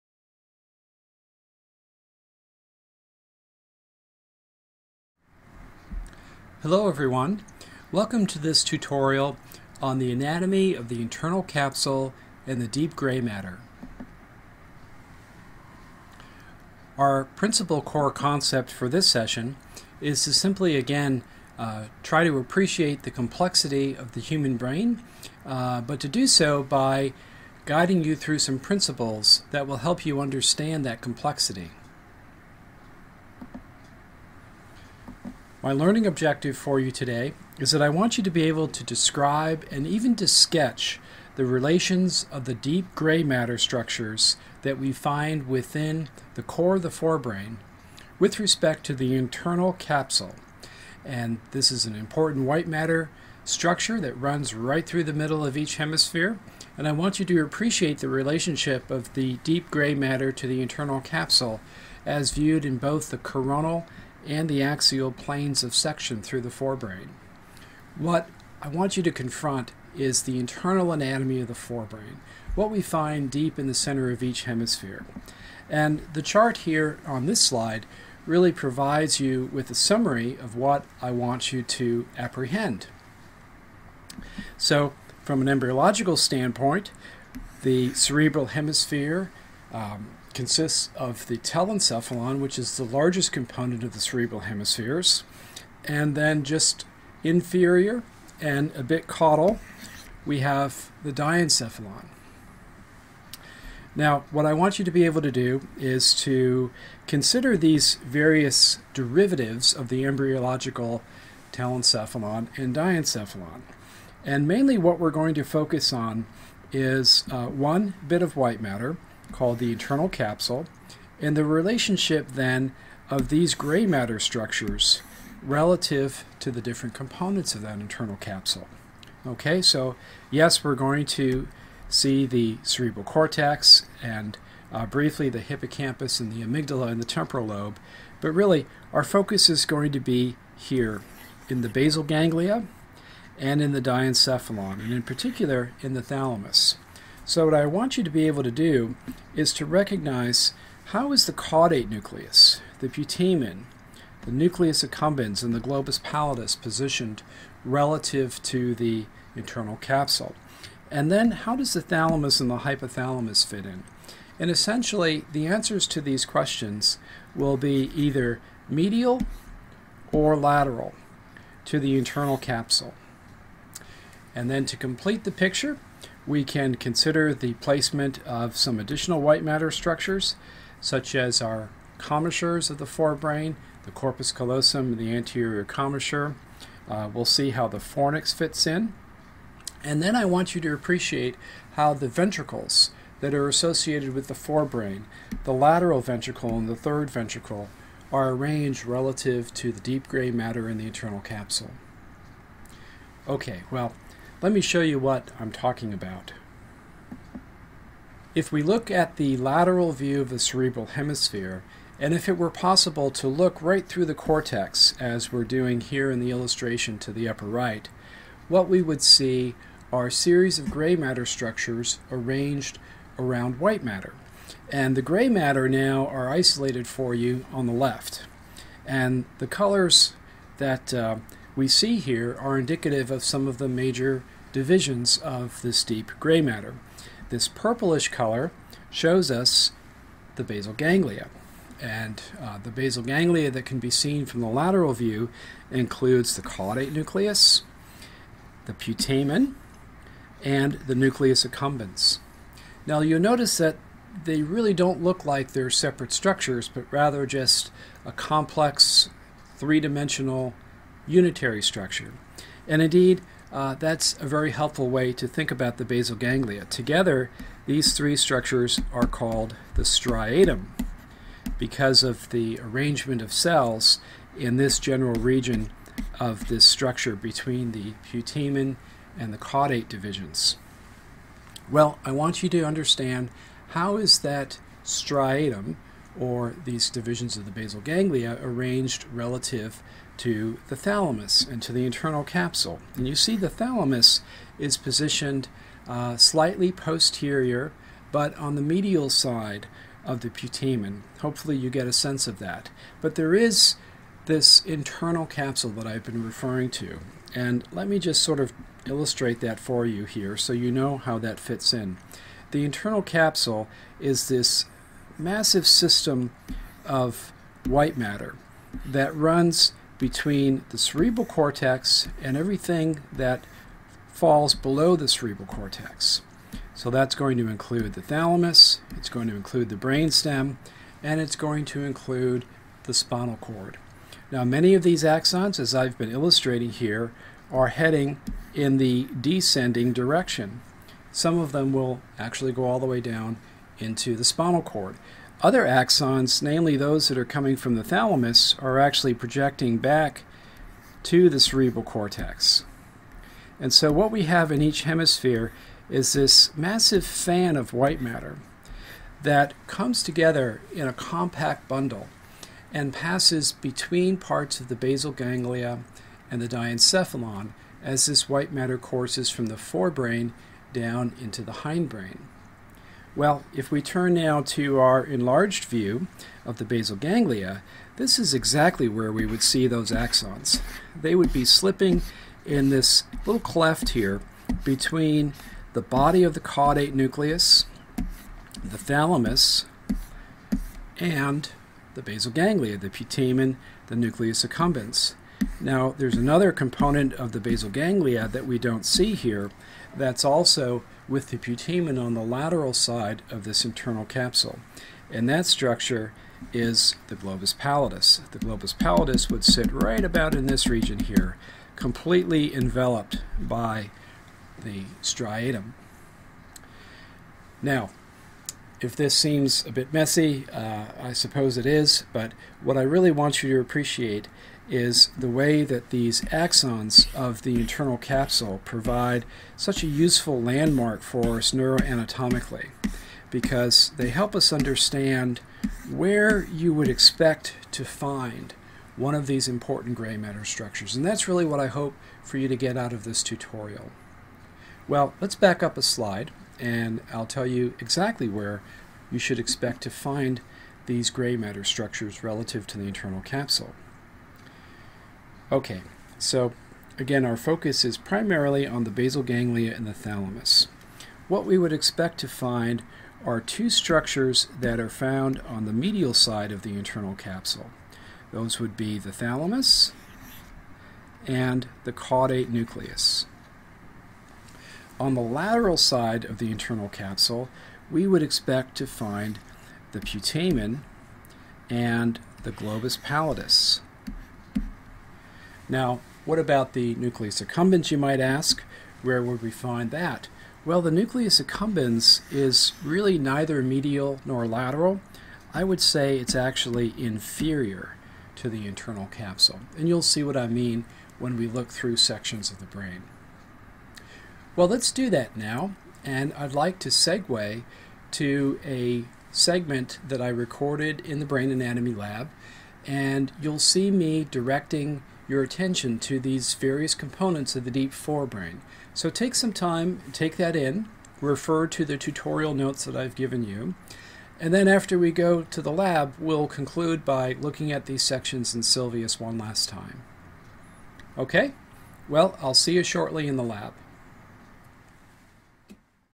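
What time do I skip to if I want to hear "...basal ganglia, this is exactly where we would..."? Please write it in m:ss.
6:16.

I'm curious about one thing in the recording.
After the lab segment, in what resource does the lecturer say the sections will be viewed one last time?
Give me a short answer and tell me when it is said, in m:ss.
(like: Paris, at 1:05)
Sylvius, at 8:48.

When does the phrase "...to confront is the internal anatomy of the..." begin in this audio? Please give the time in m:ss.
1:09.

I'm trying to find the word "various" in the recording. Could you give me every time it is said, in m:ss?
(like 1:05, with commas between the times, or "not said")
1:48, 8:36.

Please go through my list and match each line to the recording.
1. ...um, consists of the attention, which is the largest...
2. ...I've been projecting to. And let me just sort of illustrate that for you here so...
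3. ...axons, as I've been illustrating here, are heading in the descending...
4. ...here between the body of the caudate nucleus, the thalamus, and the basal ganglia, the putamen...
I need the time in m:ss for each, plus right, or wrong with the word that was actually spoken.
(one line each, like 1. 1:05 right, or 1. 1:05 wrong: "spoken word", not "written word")
1. 1:29 wrong: "telencephalon", not "attention"
2. 5:05 wrong: "referring", not "projecting"
3. 5:35 right
4. 6:23 right.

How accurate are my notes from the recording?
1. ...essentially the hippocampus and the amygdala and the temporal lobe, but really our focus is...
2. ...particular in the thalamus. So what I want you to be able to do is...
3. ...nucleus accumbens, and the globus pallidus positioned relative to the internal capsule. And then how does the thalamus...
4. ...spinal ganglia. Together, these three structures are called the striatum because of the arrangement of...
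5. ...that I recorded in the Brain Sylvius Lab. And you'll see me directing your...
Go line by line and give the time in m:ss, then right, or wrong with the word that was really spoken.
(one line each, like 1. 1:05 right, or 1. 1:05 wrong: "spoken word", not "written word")
1. 2:14 wrong: "briefly", not "essentially"
2. 2:25 right
3. 2:34 right
4. 4:25 wrong: "basal", not "spinal"
5. 8:30 wrong: "Anatomy", not "Sylvius".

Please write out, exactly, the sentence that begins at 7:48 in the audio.
Those would be the thalamus and the caudate nucleus.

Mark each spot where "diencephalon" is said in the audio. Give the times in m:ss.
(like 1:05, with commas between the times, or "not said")
1:41, 1:52, 2:23, 6:06.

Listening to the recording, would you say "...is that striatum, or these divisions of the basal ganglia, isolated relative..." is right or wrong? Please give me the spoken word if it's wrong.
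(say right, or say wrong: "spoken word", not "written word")
wrong: "arranged", not "isolated".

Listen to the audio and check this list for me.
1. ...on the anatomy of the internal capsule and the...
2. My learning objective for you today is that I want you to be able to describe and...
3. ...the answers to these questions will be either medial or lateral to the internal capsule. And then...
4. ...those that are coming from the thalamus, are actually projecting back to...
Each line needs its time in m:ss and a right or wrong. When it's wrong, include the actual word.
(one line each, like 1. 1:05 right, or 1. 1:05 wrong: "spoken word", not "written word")
1. 0:09 right
2. 0:35 right
3. 2:45 right
4. 5:46 right.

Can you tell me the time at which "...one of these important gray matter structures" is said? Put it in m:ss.
7:18.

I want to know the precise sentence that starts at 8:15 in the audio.
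I would say it's actually inferior to the internal capsule.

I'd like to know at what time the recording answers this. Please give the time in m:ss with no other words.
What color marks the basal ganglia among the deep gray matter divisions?
3:57.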